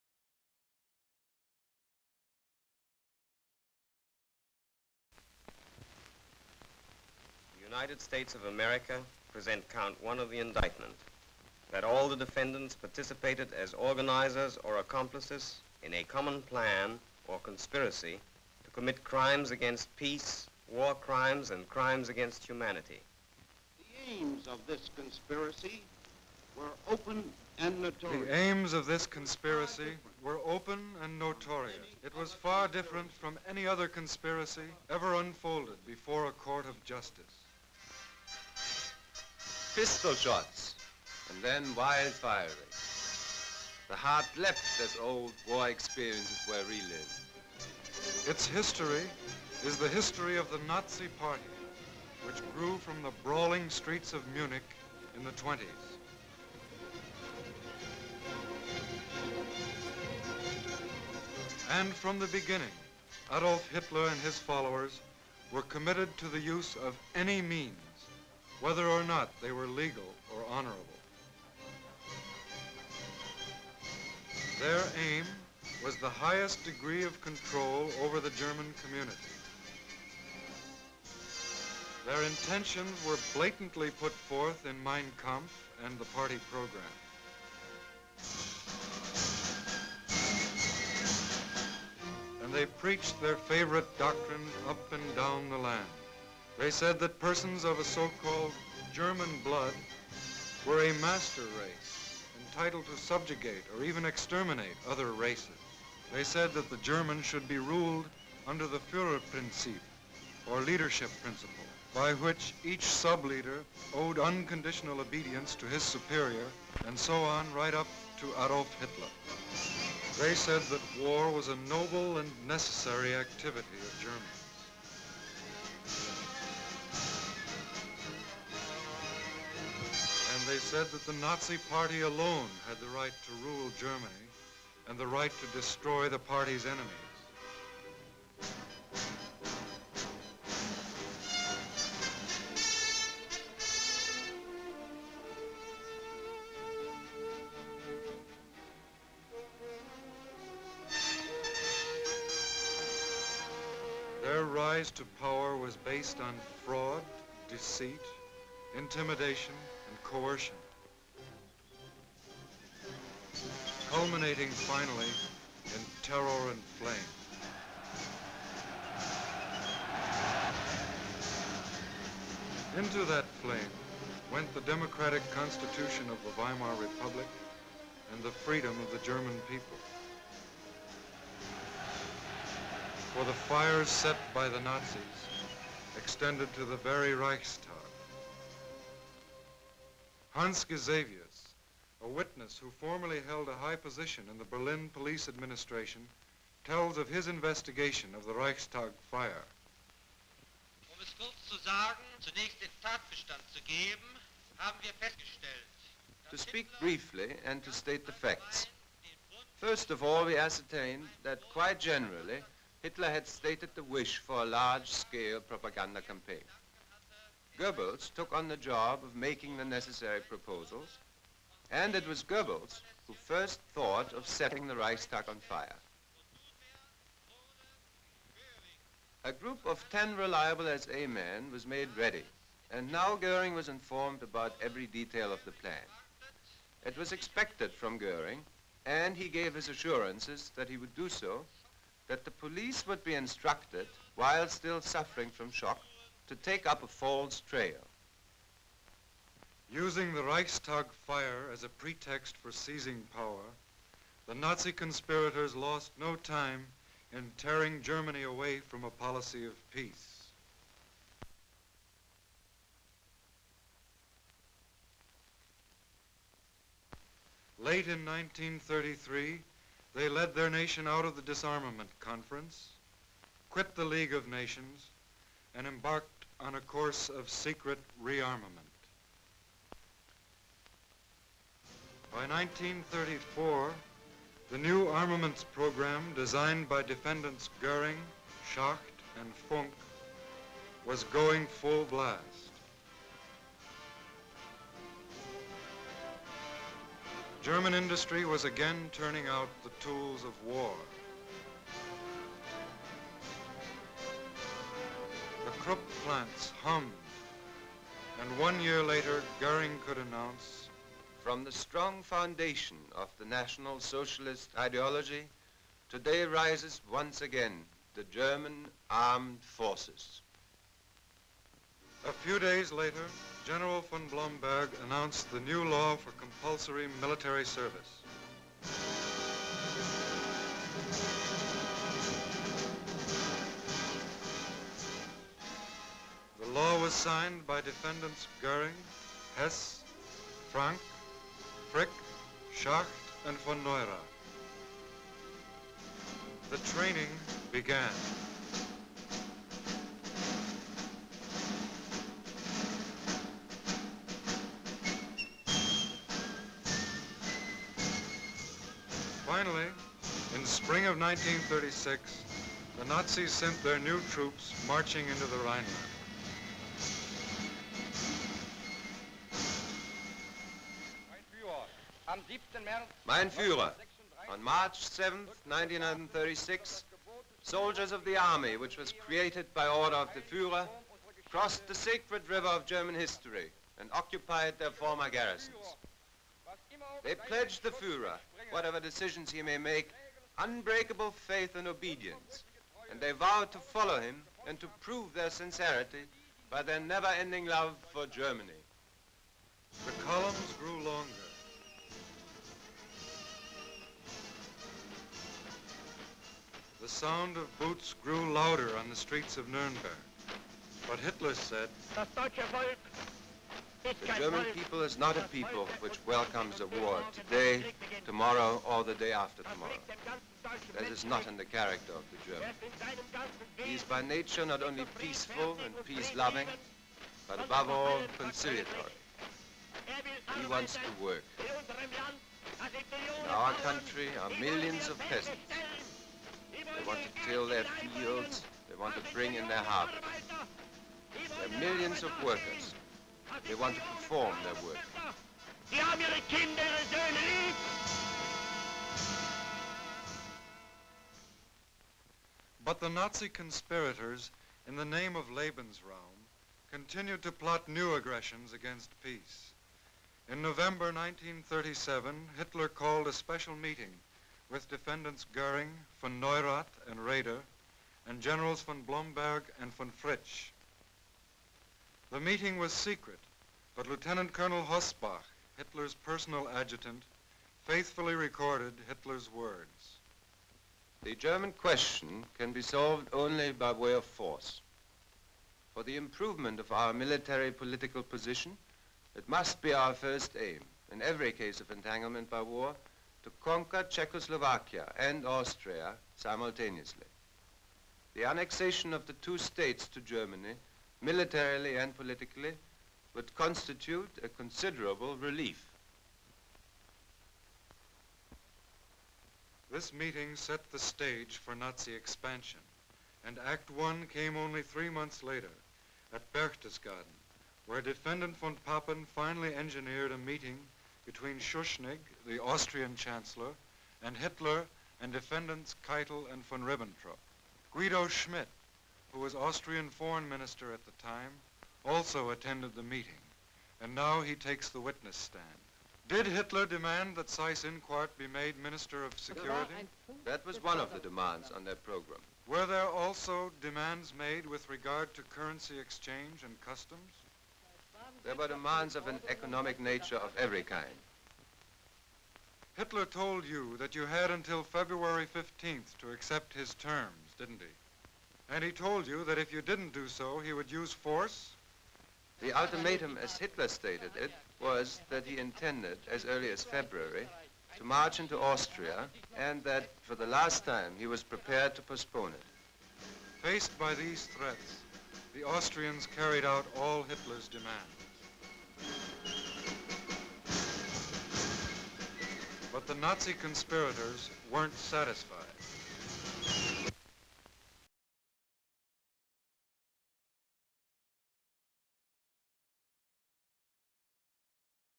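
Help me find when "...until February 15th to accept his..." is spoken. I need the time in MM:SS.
09:14.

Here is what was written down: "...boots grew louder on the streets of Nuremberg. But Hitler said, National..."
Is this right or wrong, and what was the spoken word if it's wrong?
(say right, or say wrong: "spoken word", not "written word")
wrong: "The", not "National".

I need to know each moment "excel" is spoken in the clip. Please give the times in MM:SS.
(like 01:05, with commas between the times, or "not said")
not said.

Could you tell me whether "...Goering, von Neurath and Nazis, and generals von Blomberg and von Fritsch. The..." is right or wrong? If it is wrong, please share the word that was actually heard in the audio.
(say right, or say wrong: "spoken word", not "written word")
wrong: "Raeder", not "Nazis".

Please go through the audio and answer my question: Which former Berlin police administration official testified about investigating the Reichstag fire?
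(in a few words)
Hans Gisevius.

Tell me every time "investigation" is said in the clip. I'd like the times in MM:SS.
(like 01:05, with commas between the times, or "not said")
03:17.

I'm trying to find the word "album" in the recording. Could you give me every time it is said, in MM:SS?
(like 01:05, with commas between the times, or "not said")
not said.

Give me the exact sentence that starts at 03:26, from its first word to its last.
To speak briefly and to state the facts.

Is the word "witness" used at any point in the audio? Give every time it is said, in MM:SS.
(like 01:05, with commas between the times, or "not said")
03:12, 08:54.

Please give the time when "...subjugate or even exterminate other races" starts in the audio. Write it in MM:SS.
01:42.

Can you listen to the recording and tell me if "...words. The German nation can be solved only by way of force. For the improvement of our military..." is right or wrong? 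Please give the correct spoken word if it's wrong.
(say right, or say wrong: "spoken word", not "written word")
wrong: "question", not "nation".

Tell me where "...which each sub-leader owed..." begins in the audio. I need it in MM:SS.
01:52.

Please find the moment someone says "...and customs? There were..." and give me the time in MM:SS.
09:06.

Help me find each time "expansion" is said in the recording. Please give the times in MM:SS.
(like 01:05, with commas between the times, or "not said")
08:31.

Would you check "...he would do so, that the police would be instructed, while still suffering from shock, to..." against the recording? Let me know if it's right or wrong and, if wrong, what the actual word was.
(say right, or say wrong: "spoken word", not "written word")
right.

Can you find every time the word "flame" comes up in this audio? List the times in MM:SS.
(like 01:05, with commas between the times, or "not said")
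02:46, 02:53.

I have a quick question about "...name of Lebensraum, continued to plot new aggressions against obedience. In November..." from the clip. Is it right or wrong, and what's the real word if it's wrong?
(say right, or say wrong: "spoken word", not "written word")
wrong: "peace", not "obedience".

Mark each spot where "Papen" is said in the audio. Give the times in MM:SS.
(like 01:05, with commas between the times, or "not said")
08:38.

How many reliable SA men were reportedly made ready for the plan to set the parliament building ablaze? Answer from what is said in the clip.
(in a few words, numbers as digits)
10.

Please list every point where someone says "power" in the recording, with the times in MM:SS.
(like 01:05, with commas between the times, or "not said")
02:35, 04:13.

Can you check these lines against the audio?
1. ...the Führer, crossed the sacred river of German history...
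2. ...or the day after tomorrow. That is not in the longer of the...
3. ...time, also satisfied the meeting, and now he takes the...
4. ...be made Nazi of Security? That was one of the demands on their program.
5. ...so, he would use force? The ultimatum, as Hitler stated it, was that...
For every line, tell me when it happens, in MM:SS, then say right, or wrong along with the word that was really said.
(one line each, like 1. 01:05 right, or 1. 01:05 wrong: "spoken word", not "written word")
1. 06:20 right
2. 06:58 wrong: "character", not "longer"
3. 08:51 wrong: "attended", not "satisfied"
4. 08:58 wrong: "Minister", not "Nazi"
5. 09:20 right.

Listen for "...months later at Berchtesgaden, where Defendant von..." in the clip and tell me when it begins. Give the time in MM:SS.
08:34.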